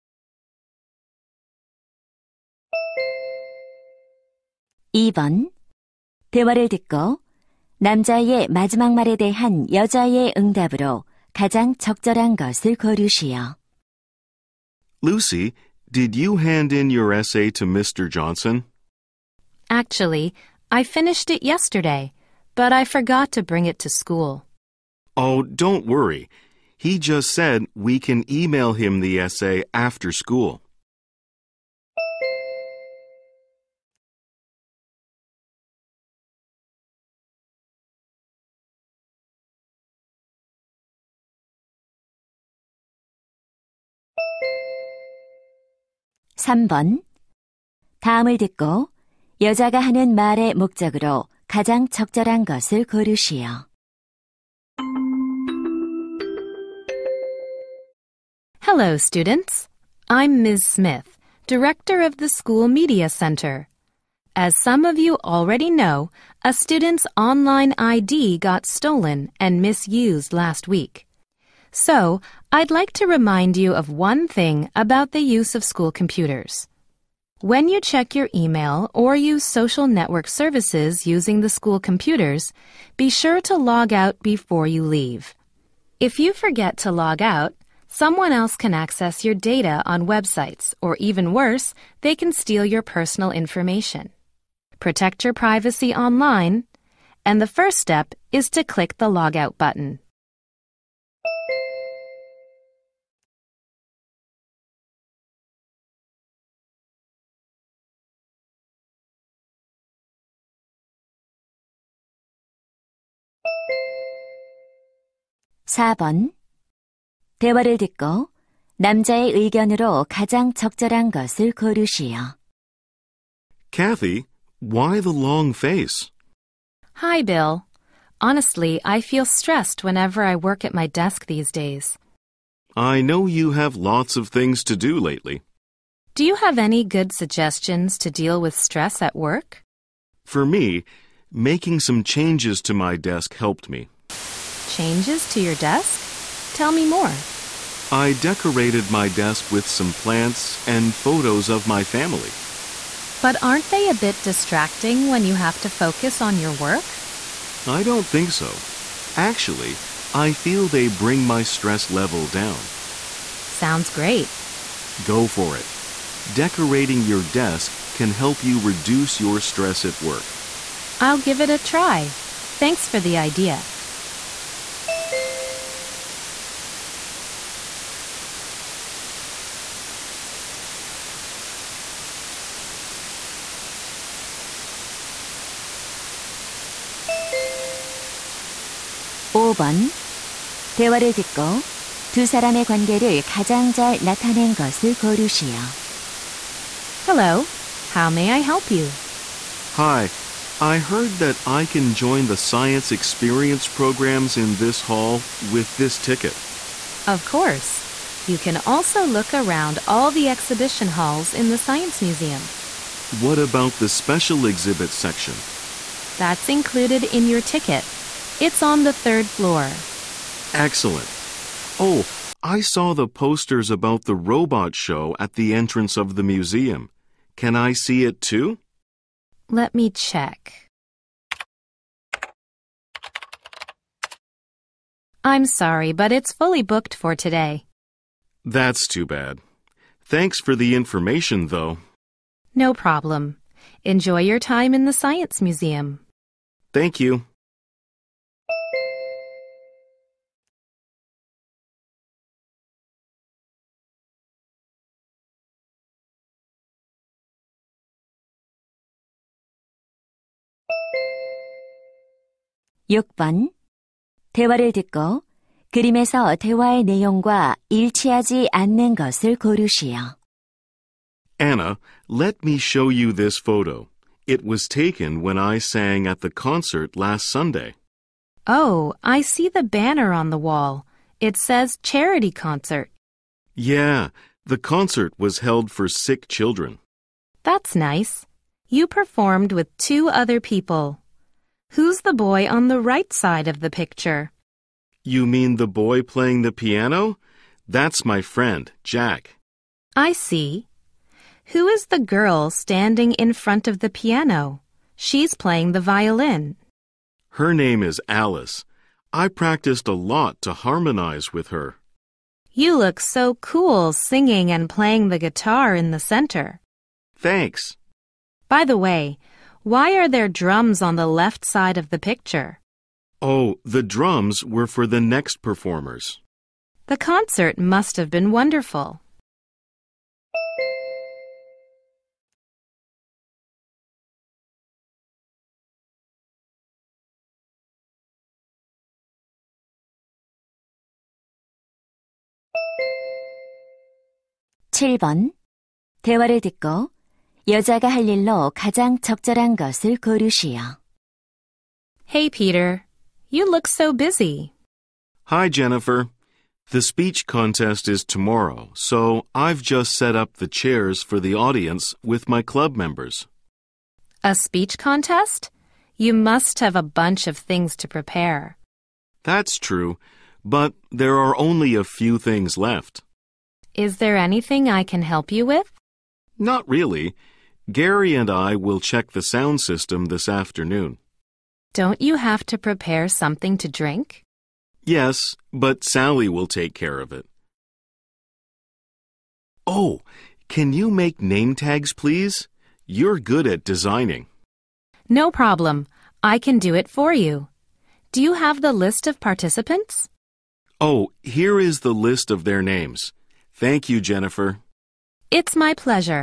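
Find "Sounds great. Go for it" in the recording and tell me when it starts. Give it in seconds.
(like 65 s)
163 s.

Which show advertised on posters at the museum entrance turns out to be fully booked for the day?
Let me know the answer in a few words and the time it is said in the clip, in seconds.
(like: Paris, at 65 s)
robot show, at 224 s.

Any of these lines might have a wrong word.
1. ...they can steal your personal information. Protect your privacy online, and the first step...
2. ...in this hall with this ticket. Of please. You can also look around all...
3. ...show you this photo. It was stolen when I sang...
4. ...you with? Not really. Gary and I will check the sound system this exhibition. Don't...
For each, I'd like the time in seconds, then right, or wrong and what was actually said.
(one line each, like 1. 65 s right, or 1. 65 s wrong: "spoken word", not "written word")
1. 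92 s right
2. 204 s wrong: "course", not "please"
3. 272 s wrong: "taken", not "stolen"
4. 375 s wrong: "afternoon", not "exhibition".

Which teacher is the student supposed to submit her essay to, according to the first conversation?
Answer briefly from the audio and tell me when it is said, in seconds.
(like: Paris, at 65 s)
Mr. Johnson, at 17 s.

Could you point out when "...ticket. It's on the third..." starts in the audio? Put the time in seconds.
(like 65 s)
217 s.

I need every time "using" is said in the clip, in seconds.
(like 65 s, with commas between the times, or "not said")
81 s.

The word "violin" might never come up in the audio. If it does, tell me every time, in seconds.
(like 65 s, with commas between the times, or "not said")
305 s.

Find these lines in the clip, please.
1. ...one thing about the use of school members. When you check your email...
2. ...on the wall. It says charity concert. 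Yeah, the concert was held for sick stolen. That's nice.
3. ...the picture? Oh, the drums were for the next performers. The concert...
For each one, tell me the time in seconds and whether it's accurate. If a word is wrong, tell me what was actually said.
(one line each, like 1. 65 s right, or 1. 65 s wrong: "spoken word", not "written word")
1. 73 s wrong: "computers", not "members"
2. 280 s wrong: "children", not "stolen"
3. 321 s right.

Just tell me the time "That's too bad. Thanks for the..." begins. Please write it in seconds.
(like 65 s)
238 s.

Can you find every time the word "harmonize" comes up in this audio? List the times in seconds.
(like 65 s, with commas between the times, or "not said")
310 s.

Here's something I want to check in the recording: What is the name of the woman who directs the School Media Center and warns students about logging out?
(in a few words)
Ms. Smith.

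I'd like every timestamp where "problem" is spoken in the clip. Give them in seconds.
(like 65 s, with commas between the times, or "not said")
242 s, 395 s.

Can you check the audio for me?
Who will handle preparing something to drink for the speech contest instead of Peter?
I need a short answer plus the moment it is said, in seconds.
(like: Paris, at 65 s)
Sally, at 385 s.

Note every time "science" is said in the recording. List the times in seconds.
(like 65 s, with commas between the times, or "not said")
202 s, 211 s, 244 s.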